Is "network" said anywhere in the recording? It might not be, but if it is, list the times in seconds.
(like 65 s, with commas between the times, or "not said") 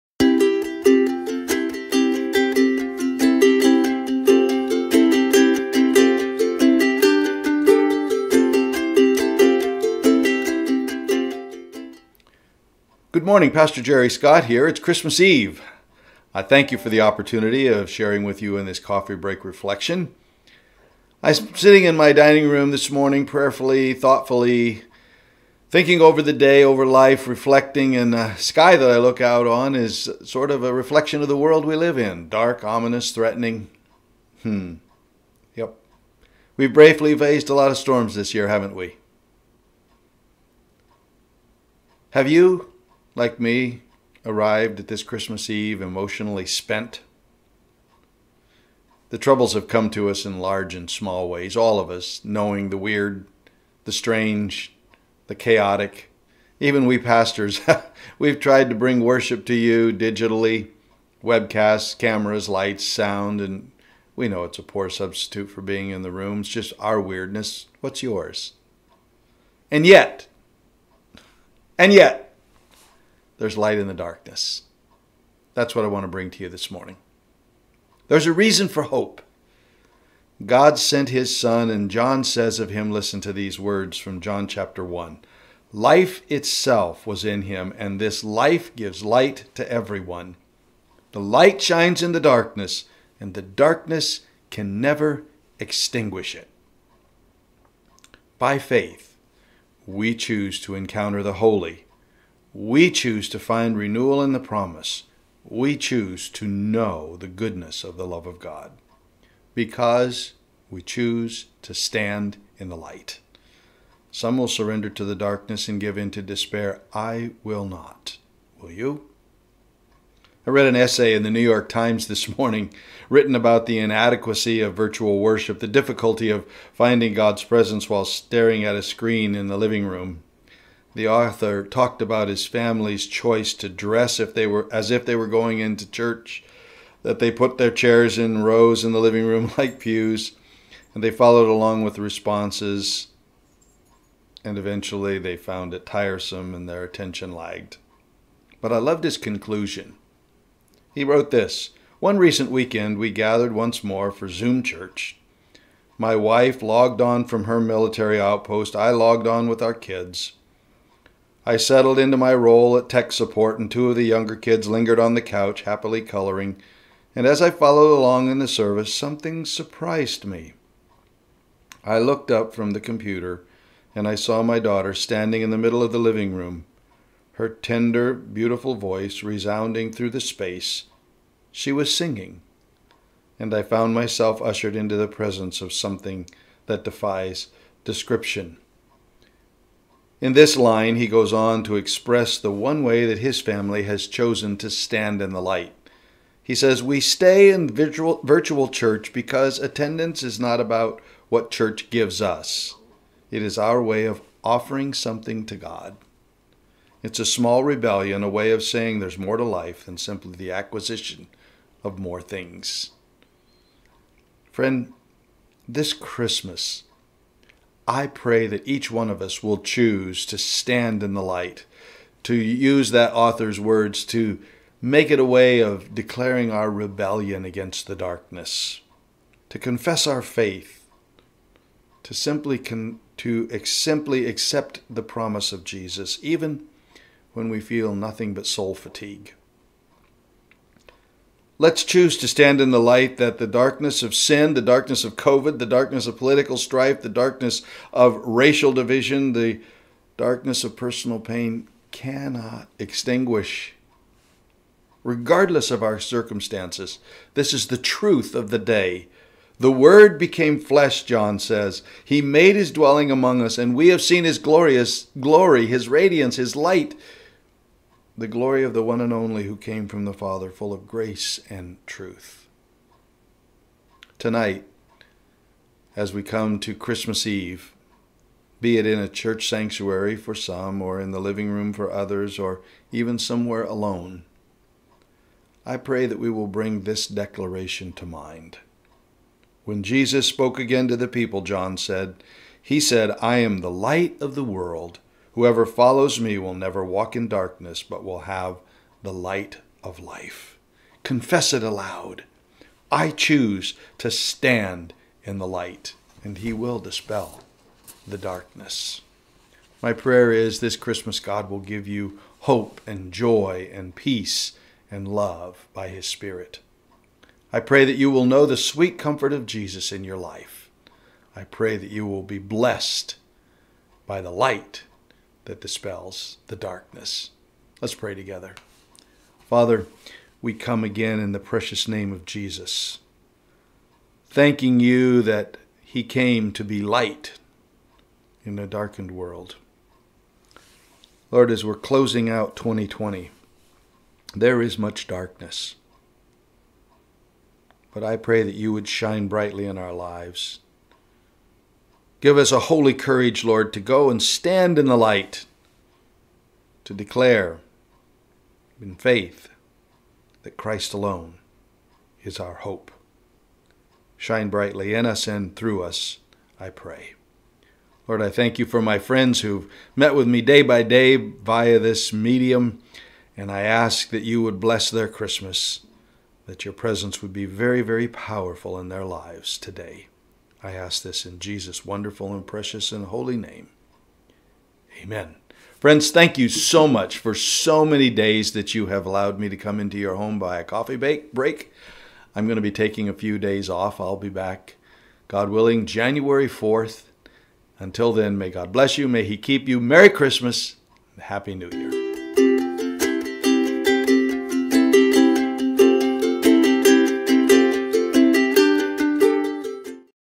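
not said.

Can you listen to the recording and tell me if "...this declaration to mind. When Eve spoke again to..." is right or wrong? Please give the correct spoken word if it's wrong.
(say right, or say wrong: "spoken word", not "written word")
wrong: "Jesus", not "Eve".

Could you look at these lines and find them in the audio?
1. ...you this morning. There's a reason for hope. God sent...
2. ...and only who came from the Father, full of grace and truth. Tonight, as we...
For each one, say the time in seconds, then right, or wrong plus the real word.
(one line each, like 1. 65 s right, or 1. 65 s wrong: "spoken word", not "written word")
1. 76 s right
2. 269 s right.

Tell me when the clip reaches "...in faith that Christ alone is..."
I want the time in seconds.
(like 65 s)
358 s.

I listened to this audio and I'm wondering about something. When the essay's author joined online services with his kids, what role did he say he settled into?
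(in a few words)
tech support.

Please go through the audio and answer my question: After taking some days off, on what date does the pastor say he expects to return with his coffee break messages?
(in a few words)
January 4th.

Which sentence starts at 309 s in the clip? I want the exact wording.
My prayer is this Christmas God will give you hope and joy and peace and love by his Spirit.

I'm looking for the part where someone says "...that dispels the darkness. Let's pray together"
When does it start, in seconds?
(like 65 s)
325 s.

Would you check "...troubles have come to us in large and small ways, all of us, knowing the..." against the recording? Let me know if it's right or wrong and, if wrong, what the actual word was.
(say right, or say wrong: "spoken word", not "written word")
right.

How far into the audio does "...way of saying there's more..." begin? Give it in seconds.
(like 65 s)
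208 s.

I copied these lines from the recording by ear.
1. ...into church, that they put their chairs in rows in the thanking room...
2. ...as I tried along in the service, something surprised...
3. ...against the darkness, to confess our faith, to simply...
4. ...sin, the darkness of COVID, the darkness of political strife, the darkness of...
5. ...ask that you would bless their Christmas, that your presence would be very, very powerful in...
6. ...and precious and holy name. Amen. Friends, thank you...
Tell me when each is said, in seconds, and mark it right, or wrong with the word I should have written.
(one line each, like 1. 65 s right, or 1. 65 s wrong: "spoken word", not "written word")
1. 135 s wrong: "living", not "thanking"
2. 167 s wrong: "followed", not "tried"
3. 227 s right
4. 244 s right
5. 373 s right
6. 382 s right.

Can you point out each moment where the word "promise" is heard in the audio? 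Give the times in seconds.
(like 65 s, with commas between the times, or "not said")
104 s, 235 s.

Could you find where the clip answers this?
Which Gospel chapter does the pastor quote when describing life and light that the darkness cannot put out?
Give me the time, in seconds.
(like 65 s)
84 s.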